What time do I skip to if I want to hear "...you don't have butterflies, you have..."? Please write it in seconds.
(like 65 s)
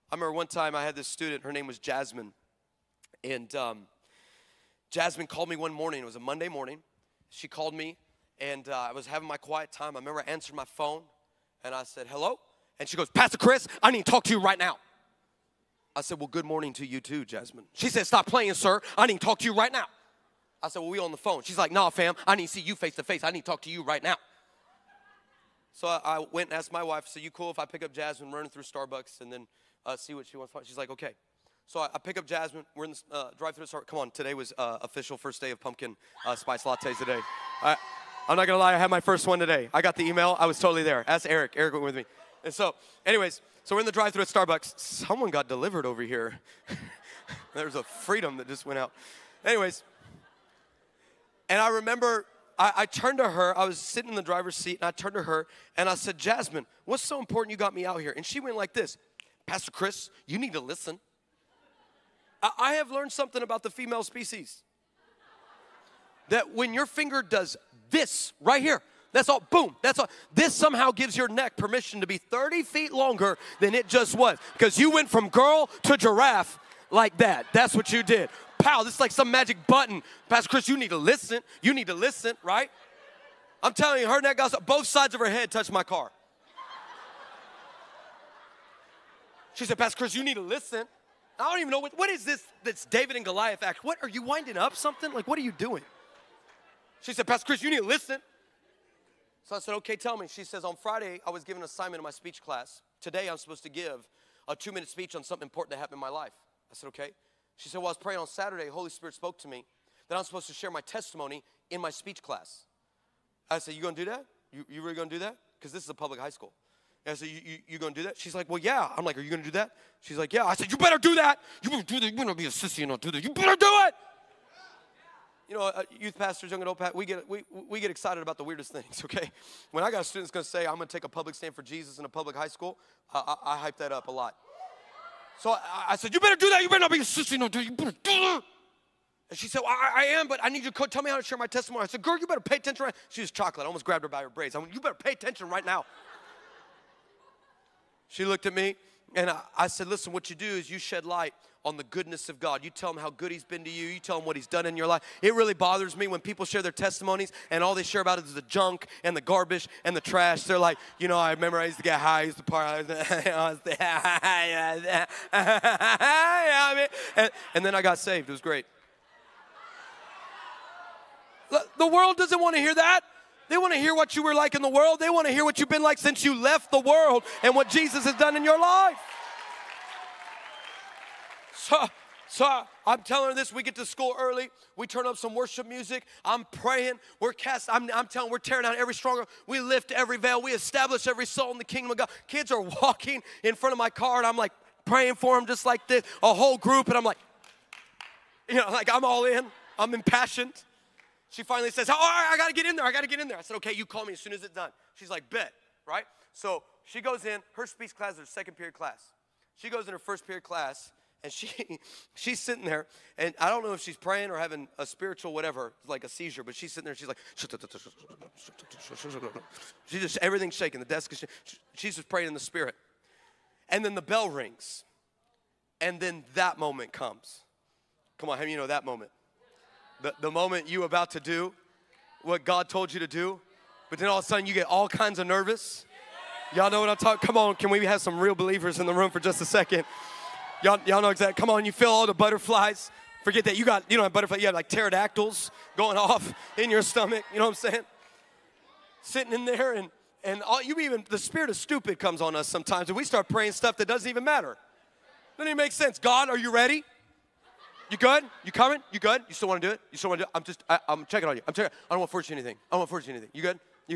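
243 s.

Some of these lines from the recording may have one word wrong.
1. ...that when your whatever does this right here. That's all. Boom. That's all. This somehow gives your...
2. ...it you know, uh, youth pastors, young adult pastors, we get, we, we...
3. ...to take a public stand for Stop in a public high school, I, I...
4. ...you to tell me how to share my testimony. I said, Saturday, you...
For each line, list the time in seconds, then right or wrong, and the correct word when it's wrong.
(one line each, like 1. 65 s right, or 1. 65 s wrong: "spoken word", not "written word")
1. 66 s wrong: "finger", not "whatever"
2. 123 s right
3. 130 s wrong: "Jesus", not "Stop"
4. 140 s wrong: "Girl", not "Saturday".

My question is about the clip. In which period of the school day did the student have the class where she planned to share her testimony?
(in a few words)
second period.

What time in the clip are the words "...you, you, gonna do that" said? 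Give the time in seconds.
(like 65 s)
117 s.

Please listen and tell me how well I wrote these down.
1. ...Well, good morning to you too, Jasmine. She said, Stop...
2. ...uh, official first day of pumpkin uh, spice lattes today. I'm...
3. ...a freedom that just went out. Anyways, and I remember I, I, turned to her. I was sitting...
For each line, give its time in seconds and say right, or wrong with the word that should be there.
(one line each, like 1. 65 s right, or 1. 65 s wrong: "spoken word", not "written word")
1. 16 s right
2. 34 s right
3. 47 s right.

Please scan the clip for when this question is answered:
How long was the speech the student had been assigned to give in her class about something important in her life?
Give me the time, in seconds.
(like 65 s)
104 s.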